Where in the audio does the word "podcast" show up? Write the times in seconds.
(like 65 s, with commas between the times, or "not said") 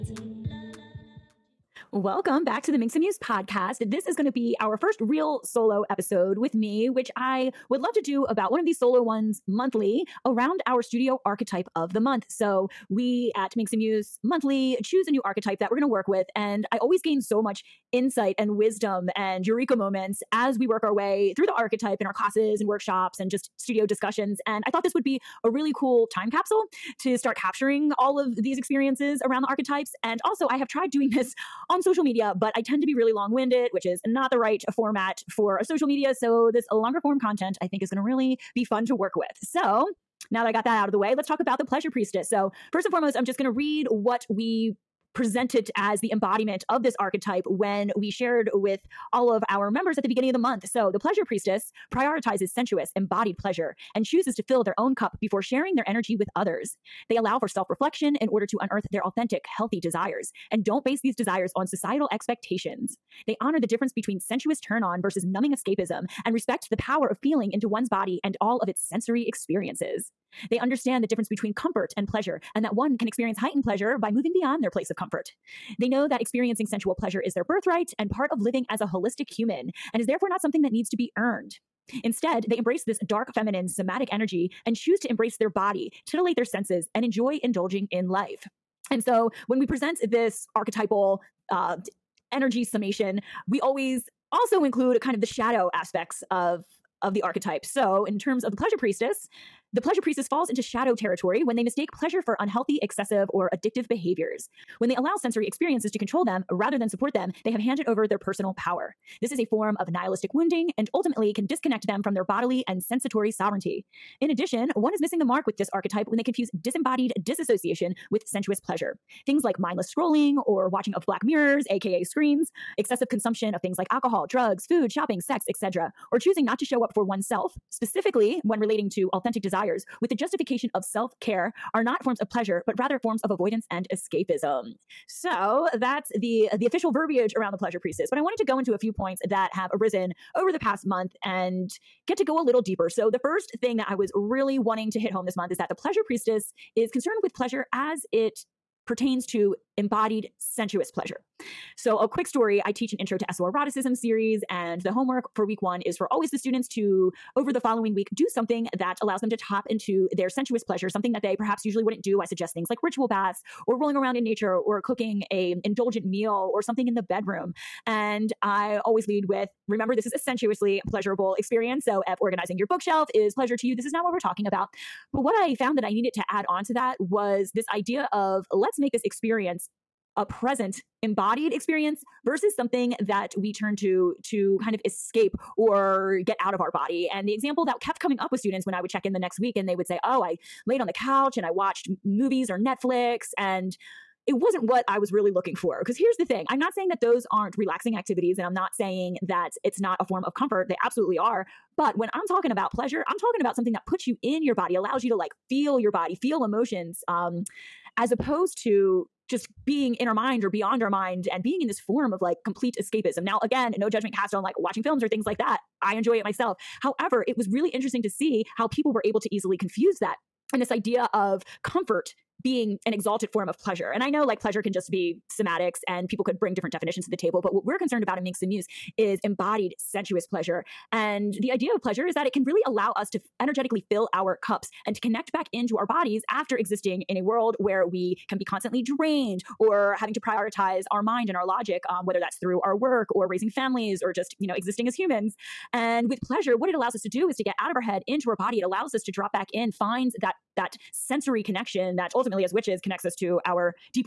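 3 s.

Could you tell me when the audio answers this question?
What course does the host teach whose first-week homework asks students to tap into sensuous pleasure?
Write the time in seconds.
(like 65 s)
152 s.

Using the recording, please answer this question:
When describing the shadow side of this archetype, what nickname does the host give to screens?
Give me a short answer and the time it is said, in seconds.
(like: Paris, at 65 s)
Black mirrors, at 121 s.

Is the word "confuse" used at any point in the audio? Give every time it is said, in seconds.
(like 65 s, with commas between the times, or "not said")
116 s, 219 s.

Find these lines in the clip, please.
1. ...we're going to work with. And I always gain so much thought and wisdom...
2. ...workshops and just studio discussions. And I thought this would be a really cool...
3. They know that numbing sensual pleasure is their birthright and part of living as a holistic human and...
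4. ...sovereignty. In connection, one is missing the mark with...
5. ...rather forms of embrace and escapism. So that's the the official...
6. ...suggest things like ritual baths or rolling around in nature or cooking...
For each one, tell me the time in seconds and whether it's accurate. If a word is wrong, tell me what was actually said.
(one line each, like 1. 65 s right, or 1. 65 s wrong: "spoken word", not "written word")
1. 15 s wrong: "insight", not "thought"
2. 22 s right
3. 75 s wrong: "experiencing", not "numbing"
4. 113 s wrong: "addition", not "connection"
5. 132 s wrong: "avoidance", not "embrace"
6. 162 s right.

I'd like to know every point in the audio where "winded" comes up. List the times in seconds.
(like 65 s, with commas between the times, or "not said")
33 s.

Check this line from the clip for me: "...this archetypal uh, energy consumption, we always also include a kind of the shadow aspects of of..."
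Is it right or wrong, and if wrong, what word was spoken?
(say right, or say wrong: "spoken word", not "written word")
wrong: "summation", not "consumption".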